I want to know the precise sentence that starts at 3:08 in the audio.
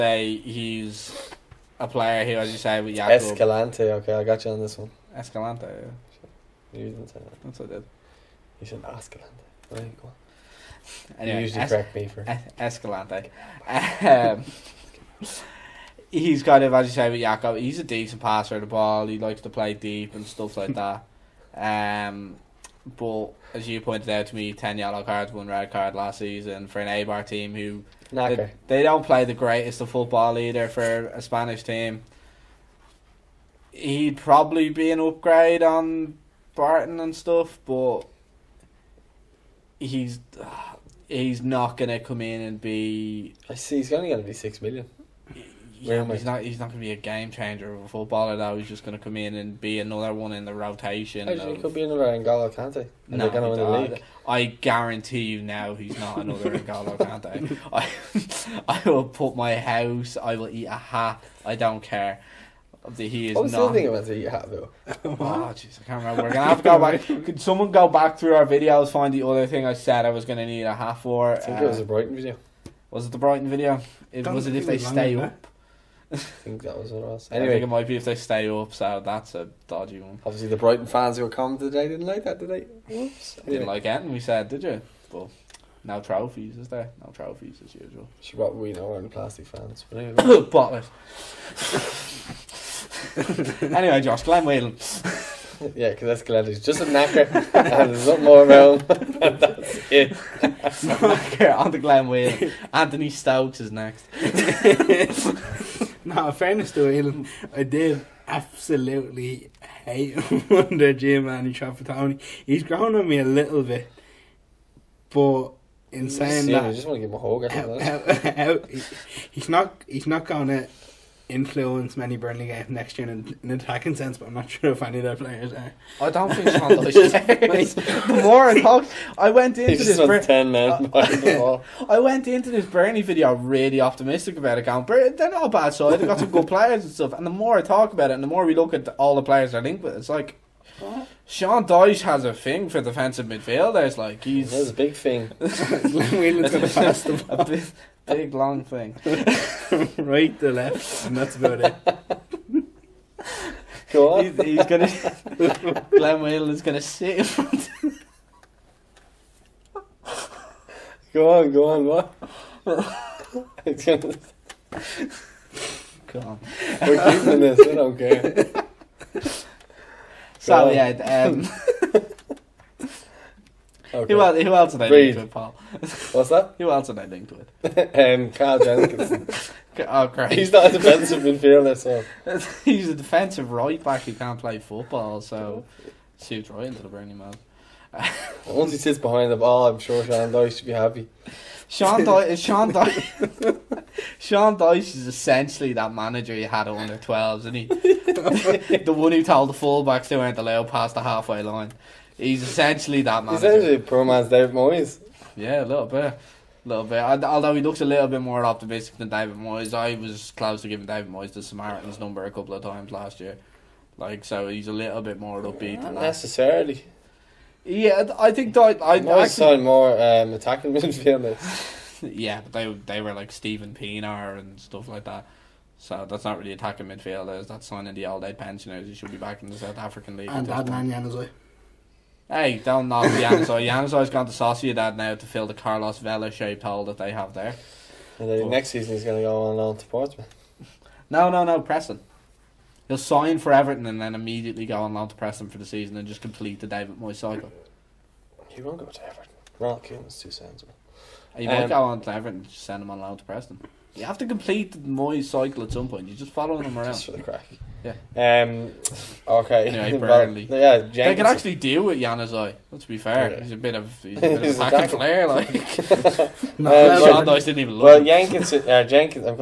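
Once he sits behind the ball, I'm sure Sean Dyche should be happy.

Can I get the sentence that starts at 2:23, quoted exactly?
Like he's that's a big thing.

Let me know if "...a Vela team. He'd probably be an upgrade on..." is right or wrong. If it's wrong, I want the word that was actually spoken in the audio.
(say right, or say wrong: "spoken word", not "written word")
wrong: "Spanish", not "Vela".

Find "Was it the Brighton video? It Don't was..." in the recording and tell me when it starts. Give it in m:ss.
1:12.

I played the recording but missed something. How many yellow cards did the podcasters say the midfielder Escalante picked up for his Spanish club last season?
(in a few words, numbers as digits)
10.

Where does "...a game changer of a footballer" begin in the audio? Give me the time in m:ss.
0:46.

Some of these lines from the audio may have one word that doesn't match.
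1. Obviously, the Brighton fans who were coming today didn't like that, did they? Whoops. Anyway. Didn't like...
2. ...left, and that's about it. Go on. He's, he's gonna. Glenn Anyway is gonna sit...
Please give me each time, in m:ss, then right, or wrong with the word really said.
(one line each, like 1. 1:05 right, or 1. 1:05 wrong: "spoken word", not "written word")
1. 1:20 right
2. 2:30 wrong: "Whelan", not "Anyway".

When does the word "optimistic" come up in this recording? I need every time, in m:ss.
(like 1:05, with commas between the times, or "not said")
2:13, 3:28.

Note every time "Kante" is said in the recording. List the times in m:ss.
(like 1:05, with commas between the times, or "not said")
0:52, 0:56.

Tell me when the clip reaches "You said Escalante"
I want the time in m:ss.
0:08.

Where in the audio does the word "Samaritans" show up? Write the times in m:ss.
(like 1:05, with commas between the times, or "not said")
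3:31.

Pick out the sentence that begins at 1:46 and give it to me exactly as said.
no, fairness to Whelan, I did absolutely hate him under Giovanni Trapattoni.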